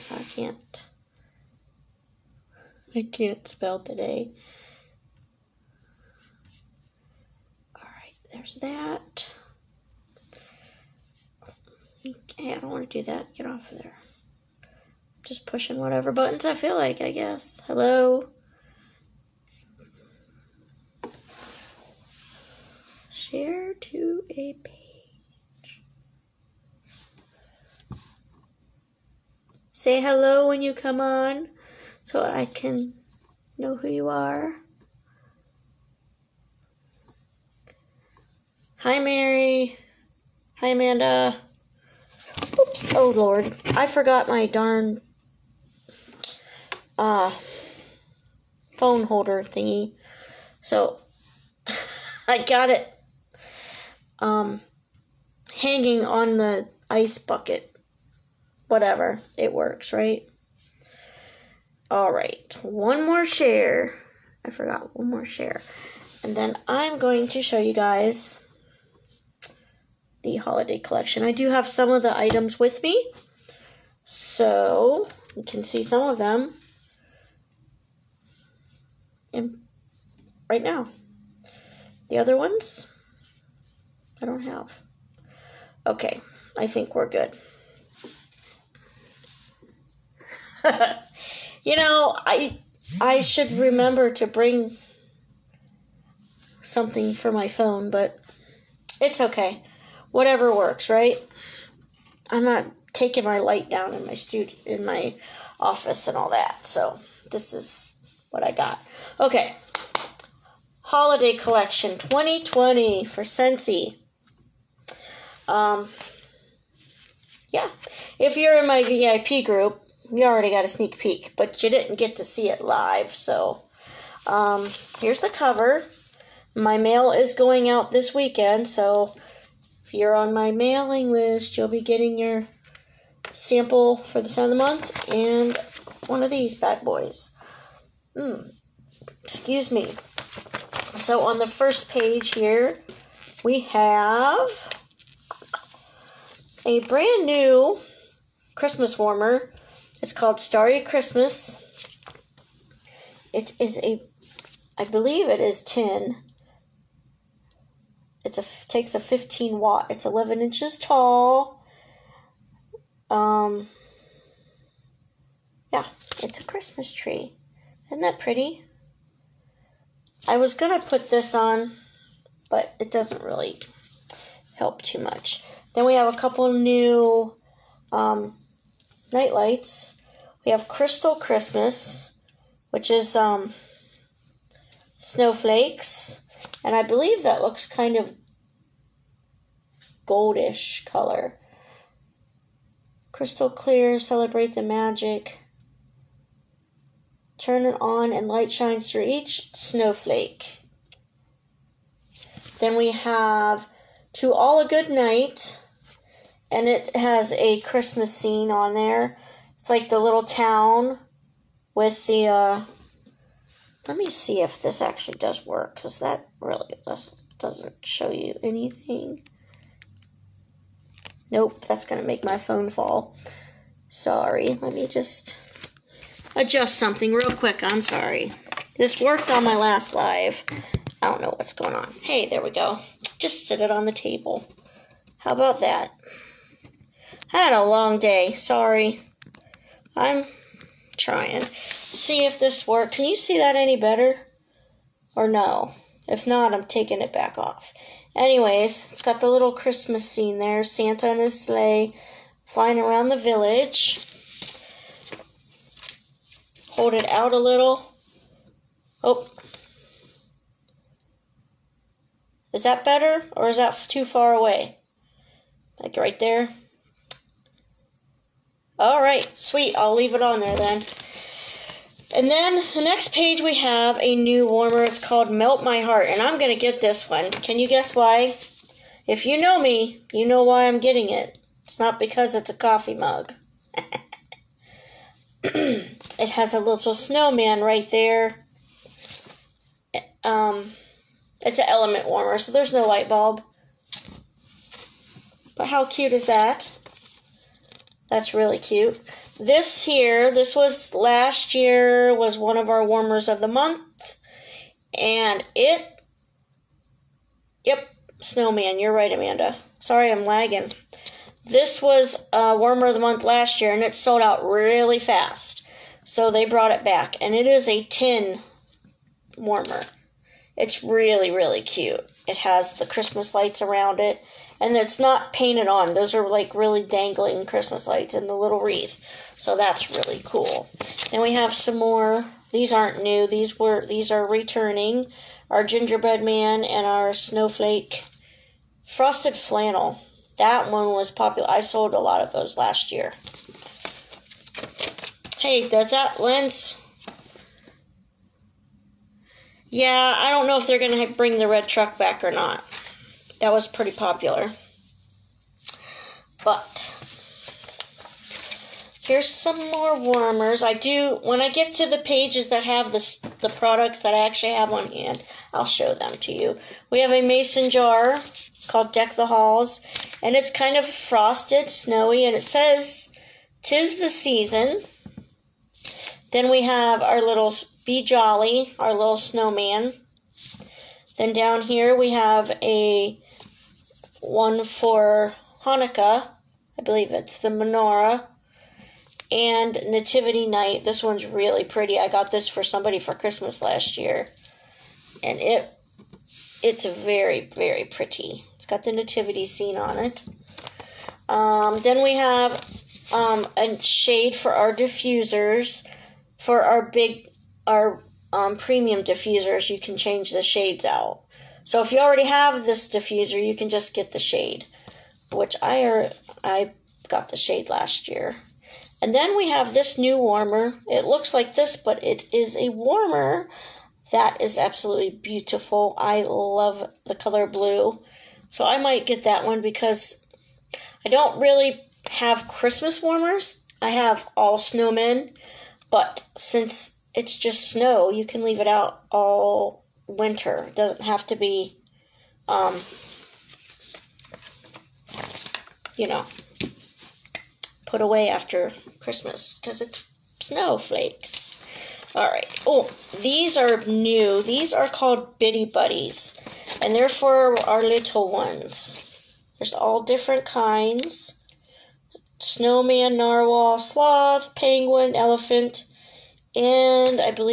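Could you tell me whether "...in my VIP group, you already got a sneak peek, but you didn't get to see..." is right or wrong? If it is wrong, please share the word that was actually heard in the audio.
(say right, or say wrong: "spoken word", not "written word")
right.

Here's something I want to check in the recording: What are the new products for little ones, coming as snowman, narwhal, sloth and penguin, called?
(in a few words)
Bitty Buddies.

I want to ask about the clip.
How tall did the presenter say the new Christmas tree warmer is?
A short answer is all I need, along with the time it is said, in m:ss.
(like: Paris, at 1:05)
11 inches, at 2:40.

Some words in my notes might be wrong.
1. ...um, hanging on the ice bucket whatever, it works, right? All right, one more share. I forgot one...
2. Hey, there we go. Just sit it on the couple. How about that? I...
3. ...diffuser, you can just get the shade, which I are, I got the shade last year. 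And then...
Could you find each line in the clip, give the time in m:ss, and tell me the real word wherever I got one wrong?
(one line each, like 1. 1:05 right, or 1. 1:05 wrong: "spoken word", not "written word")
1. 0:54 right
2. 3:52 wrong: "table", not "couple"
3. 6:52 right.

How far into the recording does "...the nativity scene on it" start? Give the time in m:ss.
6:38.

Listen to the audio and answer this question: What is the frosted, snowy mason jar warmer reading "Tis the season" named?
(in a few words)
Deck the Halls.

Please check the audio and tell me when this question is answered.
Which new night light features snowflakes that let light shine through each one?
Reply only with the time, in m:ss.
3:00.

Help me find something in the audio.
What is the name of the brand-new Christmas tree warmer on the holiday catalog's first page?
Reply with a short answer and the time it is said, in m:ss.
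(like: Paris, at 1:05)
Starry Christmas, at 2:30.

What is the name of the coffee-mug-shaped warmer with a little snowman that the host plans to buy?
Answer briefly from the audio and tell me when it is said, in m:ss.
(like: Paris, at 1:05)
Melt My Heart, at 4:35.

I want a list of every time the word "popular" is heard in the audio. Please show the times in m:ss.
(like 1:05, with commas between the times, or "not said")
5:41, 5:53.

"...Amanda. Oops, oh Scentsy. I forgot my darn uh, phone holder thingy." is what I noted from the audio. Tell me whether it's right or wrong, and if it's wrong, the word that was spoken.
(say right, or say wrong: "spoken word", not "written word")
wrong: "Lord", not "Scentsy".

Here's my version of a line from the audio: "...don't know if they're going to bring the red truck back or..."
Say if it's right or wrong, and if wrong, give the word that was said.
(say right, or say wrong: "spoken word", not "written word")
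right.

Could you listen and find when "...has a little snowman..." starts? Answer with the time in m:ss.
4:46.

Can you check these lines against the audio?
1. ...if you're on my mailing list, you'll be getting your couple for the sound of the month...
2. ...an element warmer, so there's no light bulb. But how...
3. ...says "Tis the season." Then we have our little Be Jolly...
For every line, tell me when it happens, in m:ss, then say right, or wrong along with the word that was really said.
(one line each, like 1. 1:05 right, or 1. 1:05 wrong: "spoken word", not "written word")
1. 2:09 wrong: "sample", not "couple"
2. 4:51 right
3. 6:12 right.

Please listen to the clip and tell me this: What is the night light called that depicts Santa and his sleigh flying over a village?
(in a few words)
To All a Good Night.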